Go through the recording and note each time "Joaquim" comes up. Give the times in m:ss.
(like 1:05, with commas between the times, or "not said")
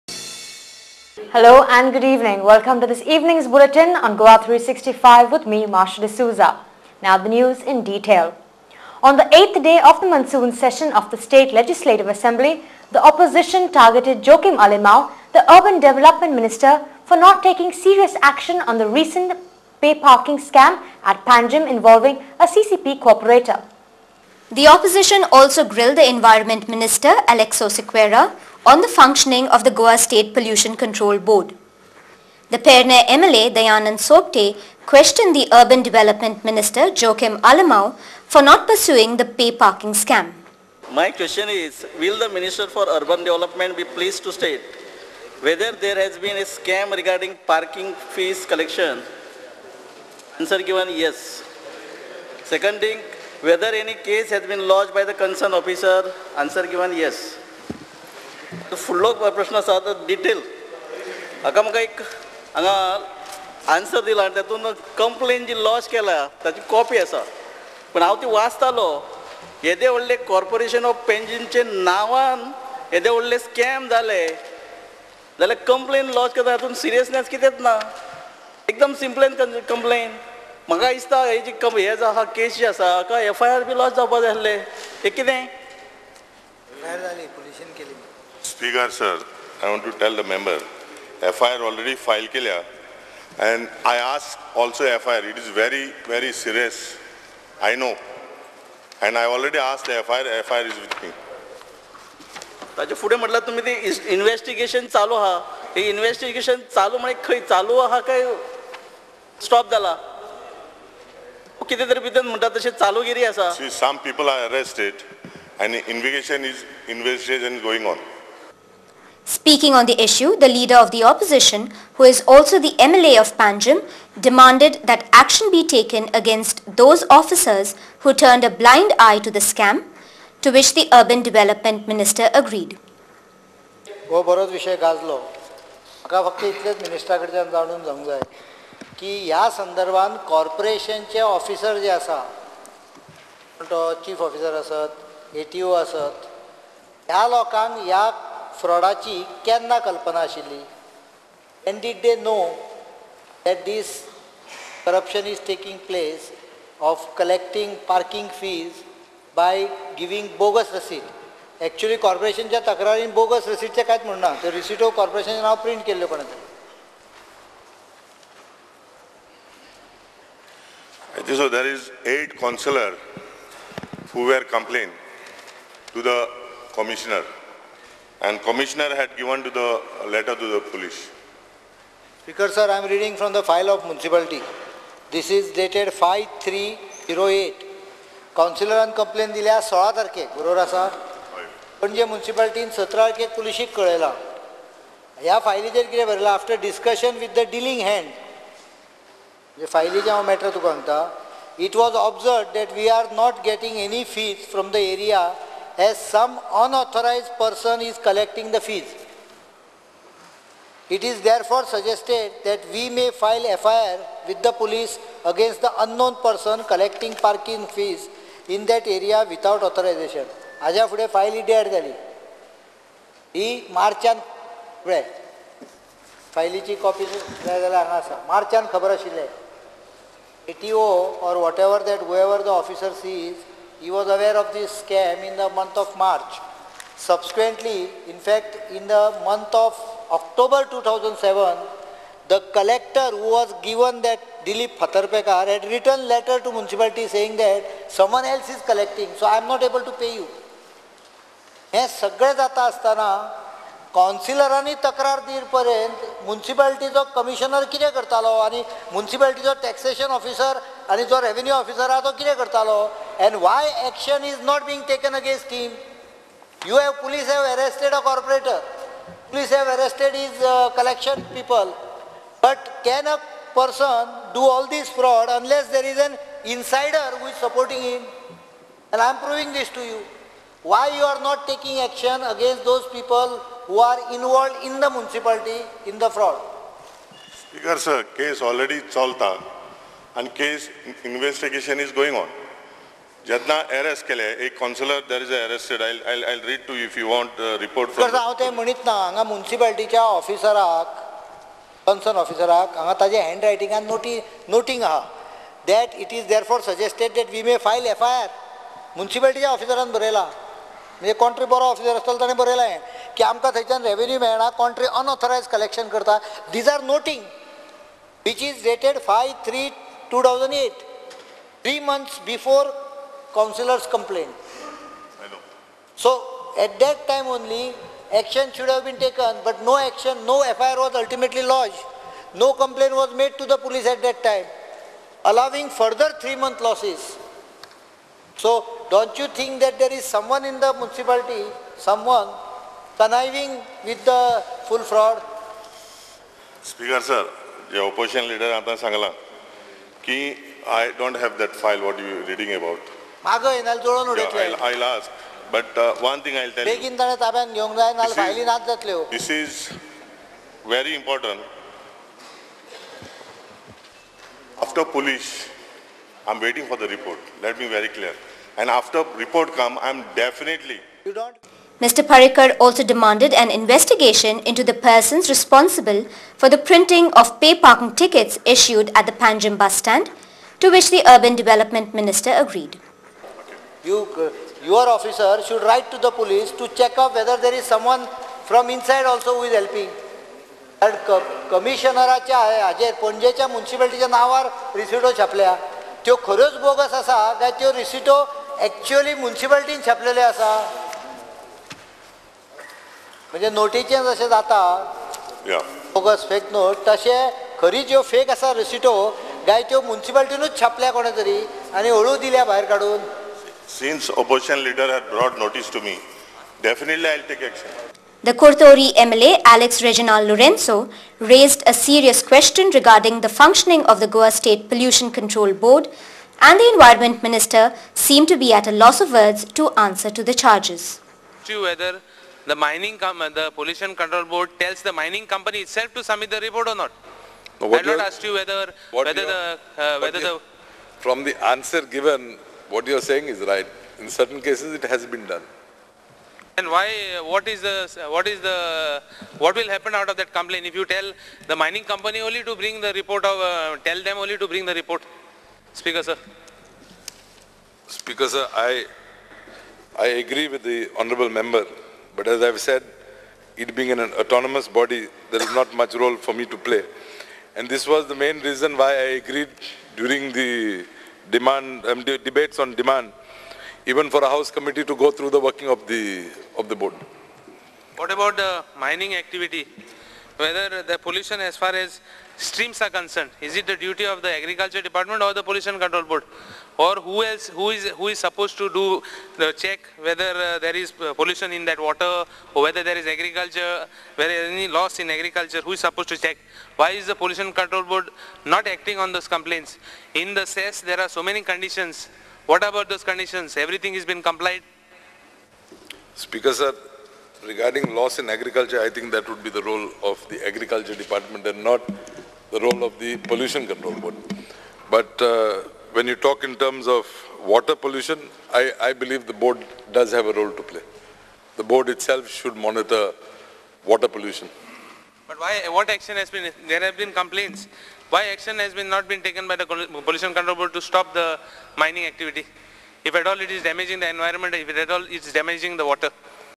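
0:14, 0:37.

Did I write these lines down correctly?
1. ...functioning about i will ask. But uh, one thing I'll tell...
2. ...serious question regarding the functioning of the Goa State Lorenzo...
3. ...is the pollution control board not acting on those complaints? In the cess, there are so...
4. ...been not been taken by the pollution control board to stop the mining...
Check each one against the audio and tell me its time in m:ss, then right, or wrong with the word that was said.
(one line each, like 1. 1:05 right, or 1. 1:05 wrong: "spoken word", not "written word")
1. 5:52 wrong: "reading", not "functioning"
2. 7:01 wrong: "Pollution", not "Lorenzo"
3. 8:17 right
4. 8:48 right.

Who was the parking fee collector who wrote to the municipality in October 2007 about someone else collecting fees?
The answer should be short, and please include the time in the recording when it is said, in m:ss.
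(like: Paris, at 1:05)
Dilip Phatarpekar, at 4:04.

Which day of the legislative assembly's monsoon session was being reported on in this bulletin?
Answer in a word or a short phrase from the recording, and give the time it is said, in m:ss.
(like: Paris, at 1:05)
Eighth day, at 0:09.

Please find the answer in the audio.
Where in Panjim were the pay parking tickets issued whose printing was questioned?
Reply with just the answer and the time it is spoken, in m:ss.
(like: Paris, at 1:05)
Panjim bus stand, at 6:19.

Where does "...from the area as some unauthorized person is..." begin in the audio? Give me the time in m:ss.
3:24.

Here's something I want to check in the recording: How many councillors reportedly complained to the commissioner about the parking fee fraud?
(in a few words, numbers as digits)
8.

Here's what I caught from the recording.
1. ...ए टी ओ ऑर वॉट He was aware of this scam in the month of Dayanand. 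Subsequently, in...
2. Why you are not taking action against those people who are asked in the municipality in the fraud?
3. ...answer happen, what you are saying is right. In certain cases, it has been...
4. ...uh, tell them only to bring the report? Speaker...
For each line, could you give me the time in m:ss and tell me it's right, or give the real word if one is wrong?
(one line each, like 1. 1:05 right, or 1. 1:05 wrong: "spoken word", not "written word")
1. 3:50 wrong: "March", not "Dayanand"
2. 4:40 wrong: "involved", not "asked"
3. 7:21 wrong: "given", not "happen"
4. 7:33 right.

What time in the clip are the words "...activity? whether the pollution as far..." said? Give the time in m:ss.
7:59.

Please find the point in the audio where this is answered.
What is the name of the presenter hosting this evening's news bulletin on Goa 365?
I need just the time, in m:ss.
0:05.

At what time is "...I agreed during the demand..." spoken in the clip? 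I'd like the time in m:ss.
7:48.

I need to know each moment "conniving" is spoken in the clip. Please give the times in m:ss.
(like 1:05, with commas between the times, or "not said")
5:42.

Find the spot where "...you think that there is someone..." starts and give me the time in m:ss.
5:39.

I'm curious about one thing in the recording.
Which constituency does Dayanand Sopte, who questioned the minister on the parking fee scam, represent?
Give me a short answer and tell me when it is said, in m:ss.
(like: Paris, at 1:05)
Pernem, at 0:32.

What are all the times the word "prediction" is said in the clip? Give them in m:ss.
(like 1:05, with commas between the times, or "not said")
not said.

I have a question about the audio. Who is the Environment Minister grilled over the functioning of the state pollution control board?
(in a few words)
Aleixo Sequeira.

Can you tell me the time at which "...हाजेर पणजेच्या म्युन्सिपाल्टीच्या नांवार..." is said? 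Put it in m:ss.
6:32.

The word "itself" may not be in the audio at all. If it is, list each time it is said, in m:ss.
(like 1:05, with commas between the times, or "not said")
7:15, 8:41.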